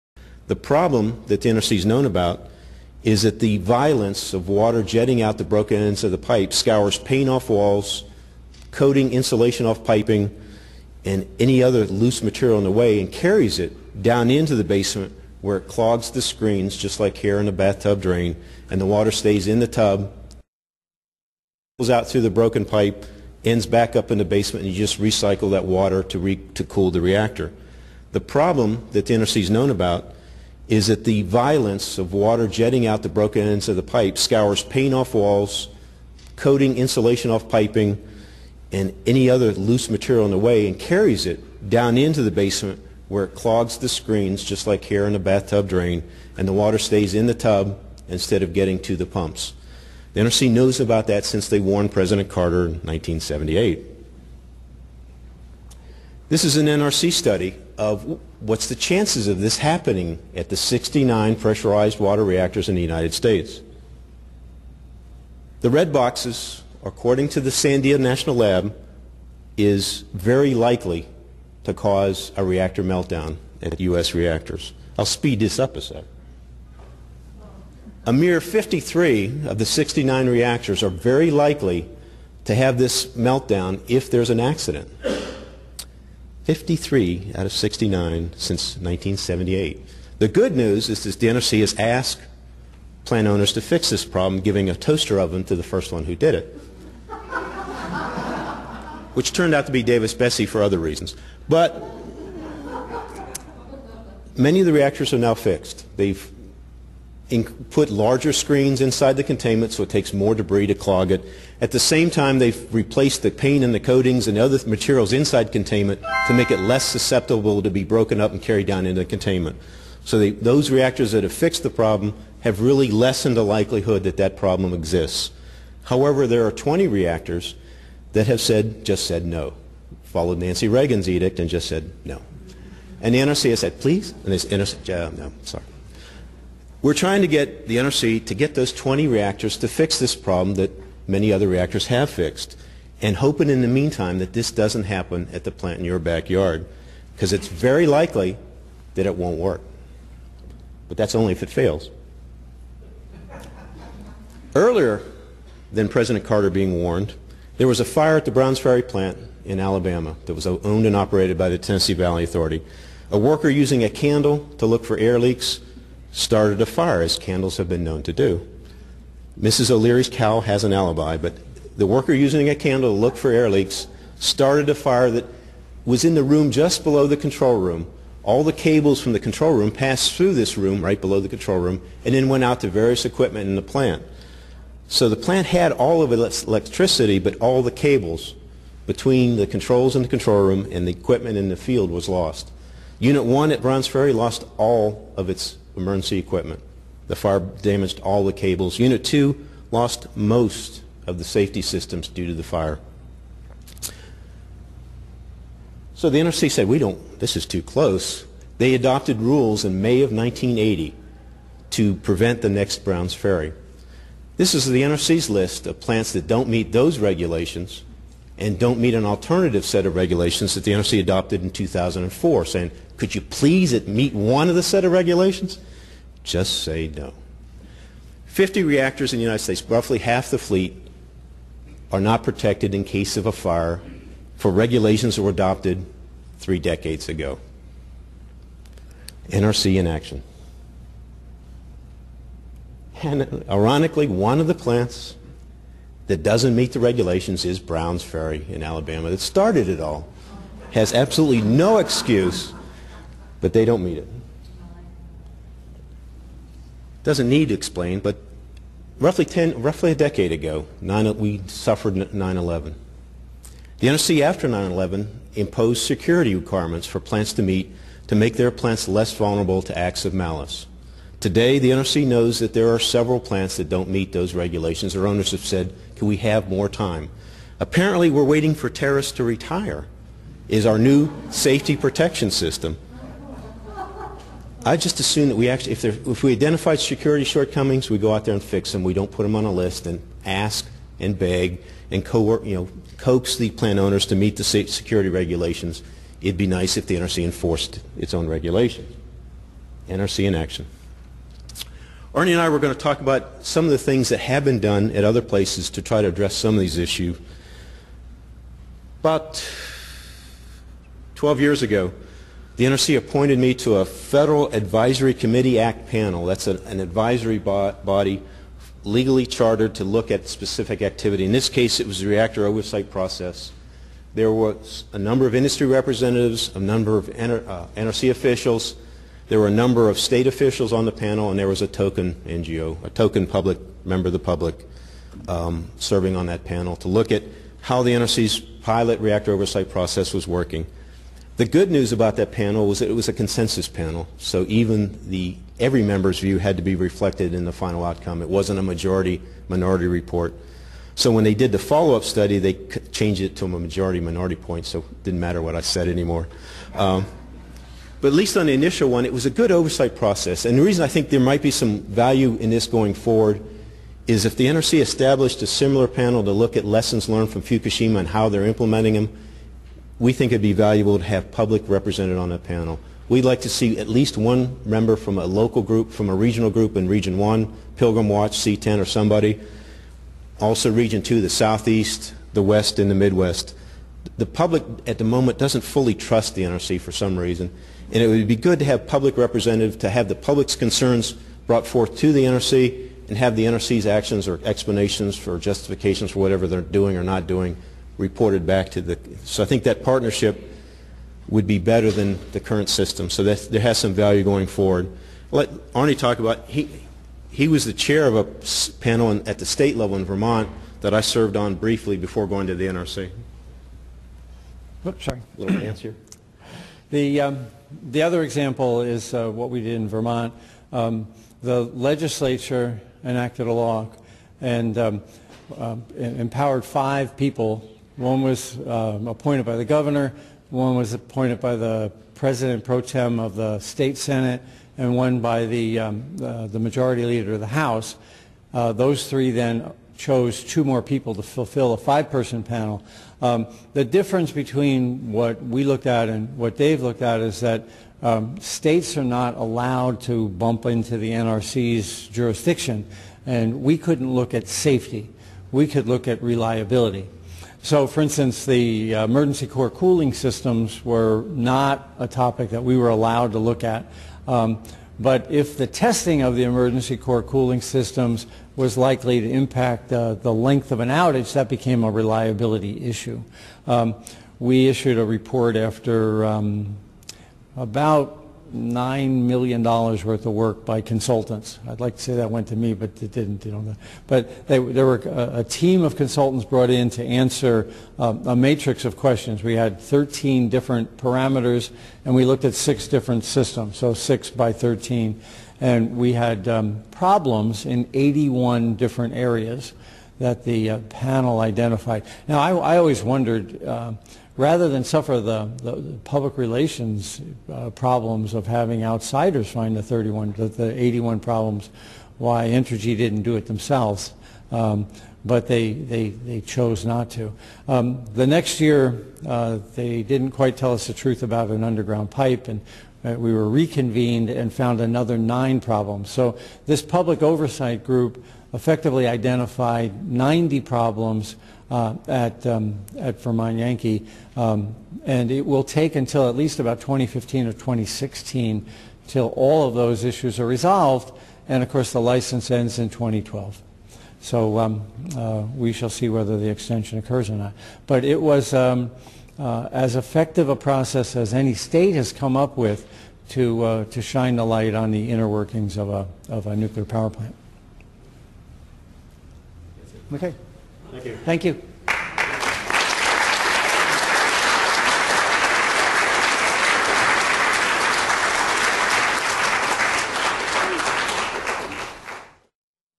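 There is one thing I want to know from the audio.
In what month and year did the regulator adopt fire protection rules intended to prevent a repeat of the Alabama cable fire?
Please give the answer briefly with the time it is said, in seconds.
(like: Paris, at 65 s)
May 1980, at 209 s.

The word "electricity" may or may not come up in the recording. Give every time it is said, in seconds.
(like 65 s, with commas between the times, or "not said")
186 s.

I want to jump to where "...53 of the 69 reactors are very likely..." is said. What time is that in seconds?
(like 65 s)
78 s.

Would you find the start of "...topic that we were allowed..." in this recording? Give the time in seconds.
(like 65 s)
462 s.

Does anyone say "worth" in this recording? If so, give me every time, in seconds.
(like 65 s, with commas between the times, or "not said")
479 s.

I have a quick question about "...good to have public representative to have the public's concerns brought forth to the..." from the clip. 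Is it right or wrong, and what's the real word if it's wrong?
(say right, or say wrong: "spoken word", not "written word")
right.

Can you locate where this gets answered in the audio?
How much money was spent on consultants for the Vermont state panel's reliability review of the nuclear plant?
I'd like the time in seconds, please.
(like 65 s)
478 s.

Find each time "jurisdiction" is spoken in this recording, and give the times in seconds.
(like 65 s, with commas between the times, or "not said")
452 s.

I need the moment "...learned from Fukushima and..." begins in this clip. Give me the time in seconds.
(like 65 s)
367 s.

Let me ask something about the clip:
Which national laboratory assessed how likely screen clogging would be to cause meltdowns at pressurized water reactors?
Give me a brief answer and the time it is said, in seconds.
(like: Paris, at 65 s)
Sandia National Lab, at 67 s.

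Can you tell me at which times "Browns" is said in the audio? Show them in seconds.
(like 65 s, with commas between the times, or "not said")
158 s, 193 s, 212 s, 247 s.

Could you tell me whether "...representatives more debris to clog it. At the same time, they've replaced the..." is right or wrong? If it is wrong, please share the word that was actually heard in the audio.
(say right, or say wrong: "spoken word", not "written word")
wrong: "takes", not "representatives".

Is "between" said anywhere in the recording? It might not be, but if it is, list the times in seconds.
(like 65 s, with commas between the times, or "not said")
188 s, 444 s.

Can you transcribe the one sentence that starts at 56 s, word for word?
This is an NRC study of what's the chances of this happening at the 69 pressurized water reactors in the United States.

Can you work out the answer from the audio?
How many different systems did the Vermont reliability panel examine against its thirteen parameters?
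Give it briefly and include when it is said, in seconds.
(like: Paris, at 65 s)
6, at 492 s.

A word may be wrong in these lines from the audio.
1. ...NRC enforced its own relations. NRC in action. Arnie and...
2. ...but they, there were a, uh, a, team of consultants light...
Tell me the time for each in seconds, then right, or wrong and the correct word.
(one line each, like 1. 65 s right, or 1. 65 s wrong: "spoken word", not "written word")
1. 296 s wrong: "regulations", not "relations"
2. 484 s wrong: "brought", not "light".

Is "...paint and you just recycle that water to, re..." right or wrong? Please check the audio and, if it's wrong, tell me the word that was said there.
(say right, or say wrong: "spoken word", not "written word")
wrong: "basement", not "paint".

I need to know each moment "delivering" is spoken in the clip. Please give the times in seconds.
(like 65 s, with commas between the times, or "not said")
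not said.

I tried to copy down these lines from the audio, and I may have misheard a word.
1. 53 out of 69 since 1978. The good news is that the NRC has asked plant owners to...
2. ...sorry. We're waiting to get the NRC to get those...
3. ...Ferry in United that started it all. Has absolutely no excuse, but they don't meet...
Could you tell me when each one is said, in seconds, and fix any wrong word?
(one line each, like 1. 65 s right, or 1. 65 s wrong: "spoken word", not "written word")
1. 86 s right
2. 135 s wrong: "trying", not "waiting"
3. 248 s wrong: "Alabama", not "United".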